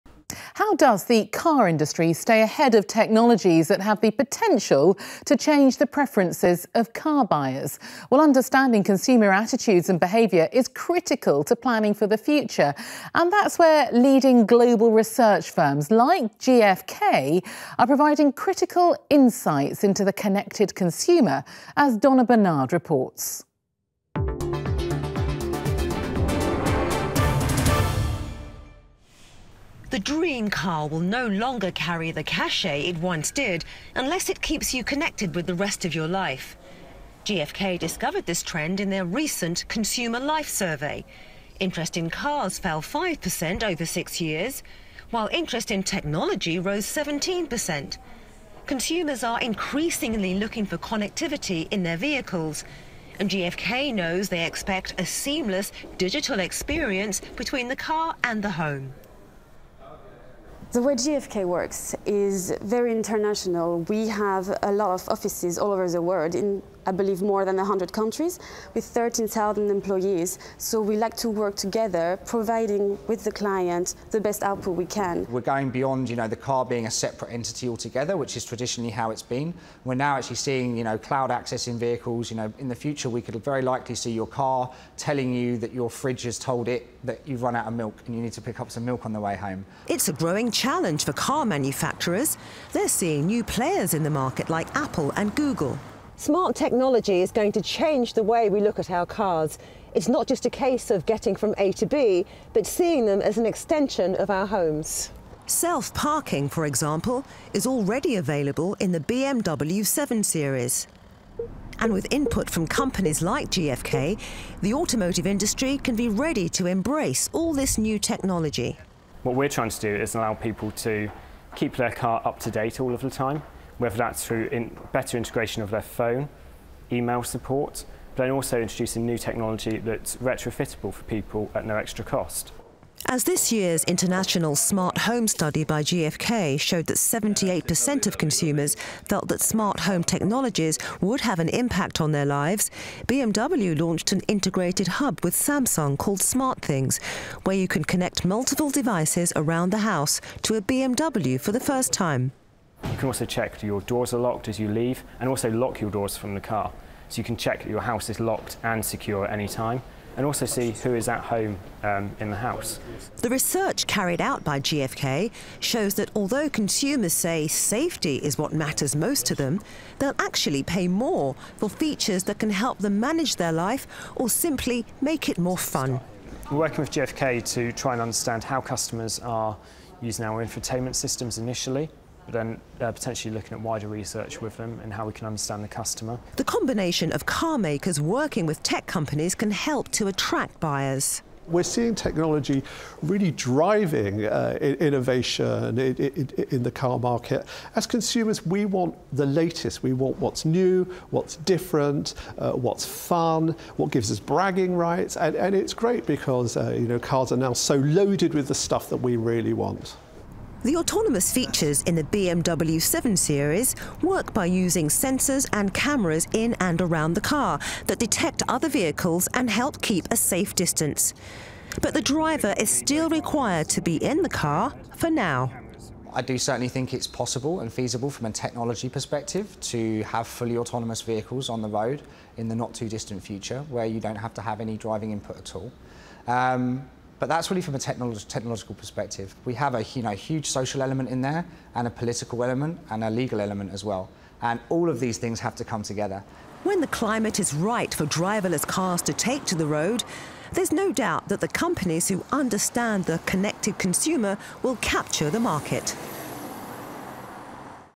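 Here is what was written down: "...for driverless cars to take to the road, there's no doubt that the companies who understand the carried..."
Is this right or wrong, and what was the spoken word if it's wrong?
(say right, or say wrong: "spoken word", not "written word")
wrong: "connected", not "carried".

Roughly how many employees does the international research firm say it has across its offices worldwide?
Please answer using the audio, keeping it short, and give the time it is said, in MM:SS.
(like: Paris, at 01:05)
13,000, at 01:08.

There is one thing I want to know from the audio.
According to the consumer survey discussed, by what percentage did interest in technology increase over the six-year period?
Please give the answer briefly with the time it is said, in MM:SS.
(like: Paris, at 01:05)
17%, at 00:46.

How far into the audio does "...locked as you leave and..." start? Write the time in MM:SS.
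02:34.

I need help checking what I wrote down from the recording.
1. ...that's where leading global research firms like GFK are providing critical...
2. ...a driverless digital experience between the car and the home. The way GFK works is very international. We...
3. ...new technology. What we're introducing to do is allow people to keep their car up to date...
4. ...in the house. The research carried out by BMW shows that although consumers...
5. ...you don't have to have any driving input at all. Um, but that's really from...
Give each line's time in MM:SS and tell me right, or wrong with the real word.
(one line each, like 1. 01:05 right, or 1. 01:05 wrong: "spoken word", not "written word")
1. 00:13 right
2. 00:55 wrong: "seamless", not "driverless"
3. 01:57 wrong: "trying", not "introducing"
4. 02:42 wrong: "GFK", not "BMW"
5. 03:53 right.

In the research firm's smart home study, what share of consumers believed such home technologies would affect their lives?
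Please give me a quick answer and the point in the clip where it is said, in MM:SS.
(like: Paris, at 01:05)
78%, at 02:16.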